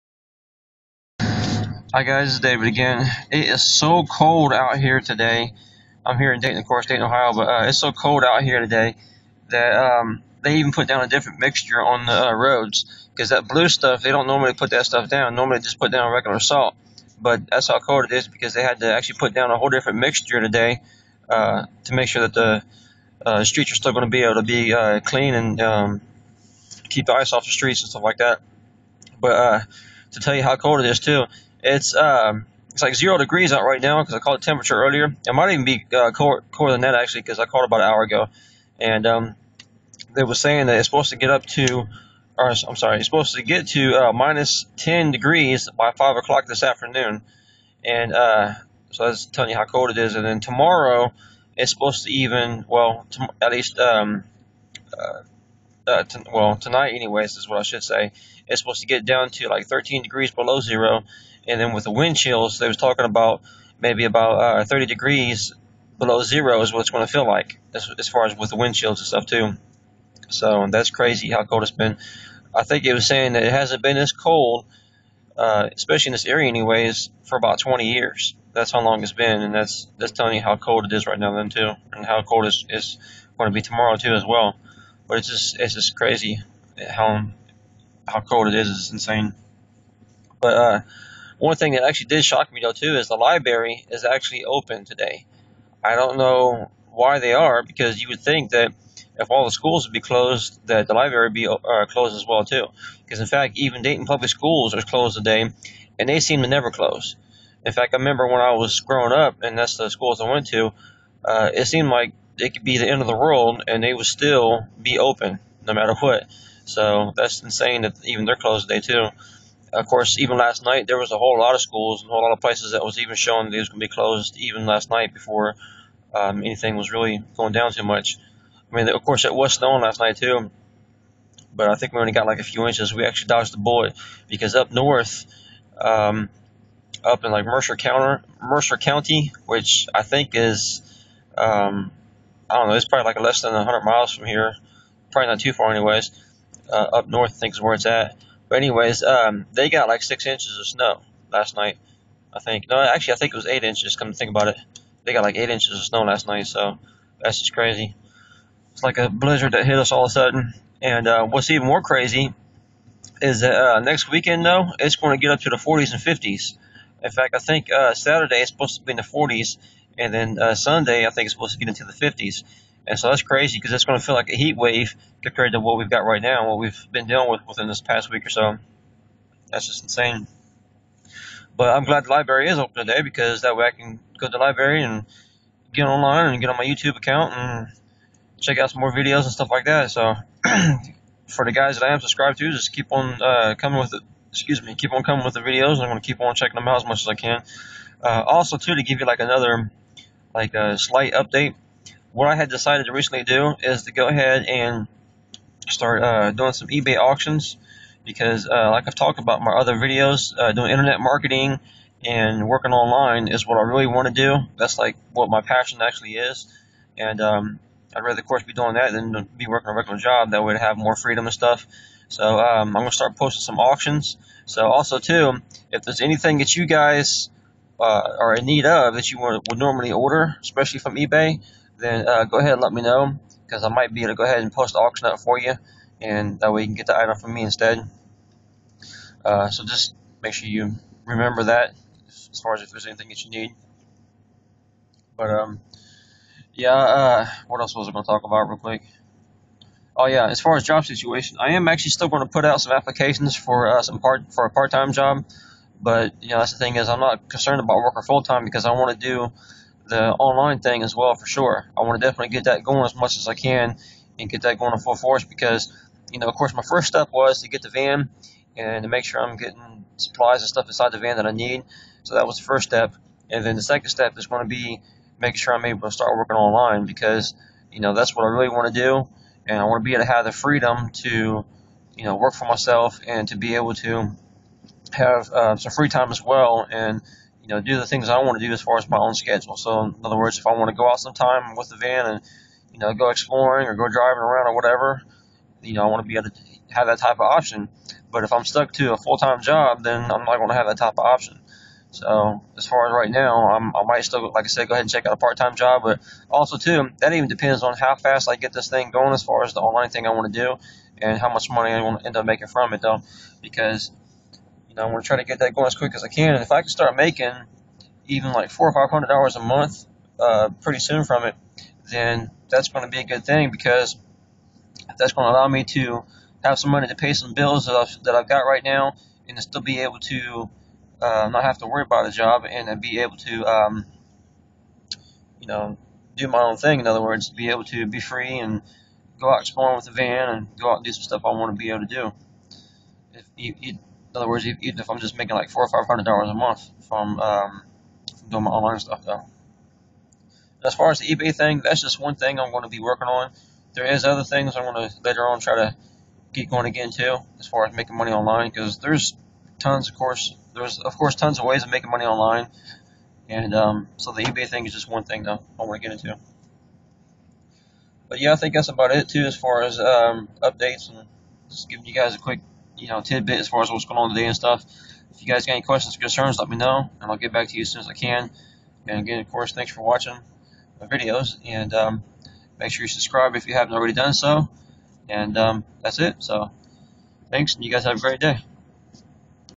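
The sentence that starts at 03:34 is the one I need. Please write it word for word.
That's like what my passion actually is, and um, I'd rather, of course, be doing that than be working a regular job.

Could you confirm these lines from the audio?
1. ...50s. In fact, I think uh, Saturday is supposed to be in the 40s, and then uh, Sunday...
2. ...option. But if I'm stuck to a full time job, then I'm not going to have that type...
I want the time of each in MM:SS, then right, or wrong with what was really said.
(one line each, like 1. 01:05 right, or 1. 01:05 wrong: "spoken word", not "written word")
1. 02:46 right
2. 04:57 right.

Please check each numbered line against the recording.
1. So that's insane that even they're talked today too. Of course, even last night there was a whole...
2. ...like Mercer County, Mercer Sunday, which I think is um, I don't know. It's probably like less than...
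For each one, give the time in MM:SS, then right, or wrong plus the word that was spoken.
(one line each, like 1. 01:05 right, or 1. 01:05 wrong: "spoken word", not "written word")
1. 01:56 wrong: "closed", not "talked"
2. 02:17 wrong: "County", not "Sunday".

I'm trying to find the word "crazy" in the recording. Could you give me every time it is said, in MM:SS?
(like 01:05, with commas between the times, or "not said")
01:10, 01:25, 02:37, 02:41, 02:53.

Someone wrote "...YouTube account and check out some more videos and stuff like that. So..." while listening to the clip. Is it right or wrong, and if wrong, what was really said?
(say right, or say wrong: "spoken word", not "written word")
right.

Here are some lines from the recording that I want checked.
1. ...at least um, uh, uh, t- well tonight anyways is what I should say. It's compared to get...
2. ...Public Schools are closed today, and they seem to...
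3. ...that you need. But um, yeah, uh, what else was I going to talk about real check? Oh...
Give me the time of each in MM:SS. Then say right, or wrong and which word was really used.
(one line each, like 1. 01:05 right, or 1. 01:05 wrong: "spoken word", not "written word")
1. 00:53 wrong: "supposed", not "compared"
2. 01:44 right
3. 04:03 wrong: "quick", not "check".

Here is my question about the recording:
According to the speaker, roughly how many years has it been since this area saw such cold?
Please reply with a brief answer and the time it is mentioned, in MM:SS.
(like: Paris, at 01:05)
20 years, at 01:17.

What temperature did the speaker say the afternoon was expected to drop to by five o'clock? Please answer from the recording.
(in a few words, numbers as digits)
-10 degrees.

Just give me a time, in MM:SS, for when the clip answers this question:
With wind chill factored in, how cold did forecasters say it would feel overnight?
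01:04.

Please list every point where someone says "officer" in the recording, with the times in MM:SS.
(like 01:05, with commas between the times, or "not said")
not said.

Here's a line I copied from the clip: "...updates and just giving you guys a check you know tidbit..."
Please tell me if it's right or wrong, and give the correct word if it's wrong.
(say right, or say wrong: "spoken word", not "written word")
wrong: "quick", not "check".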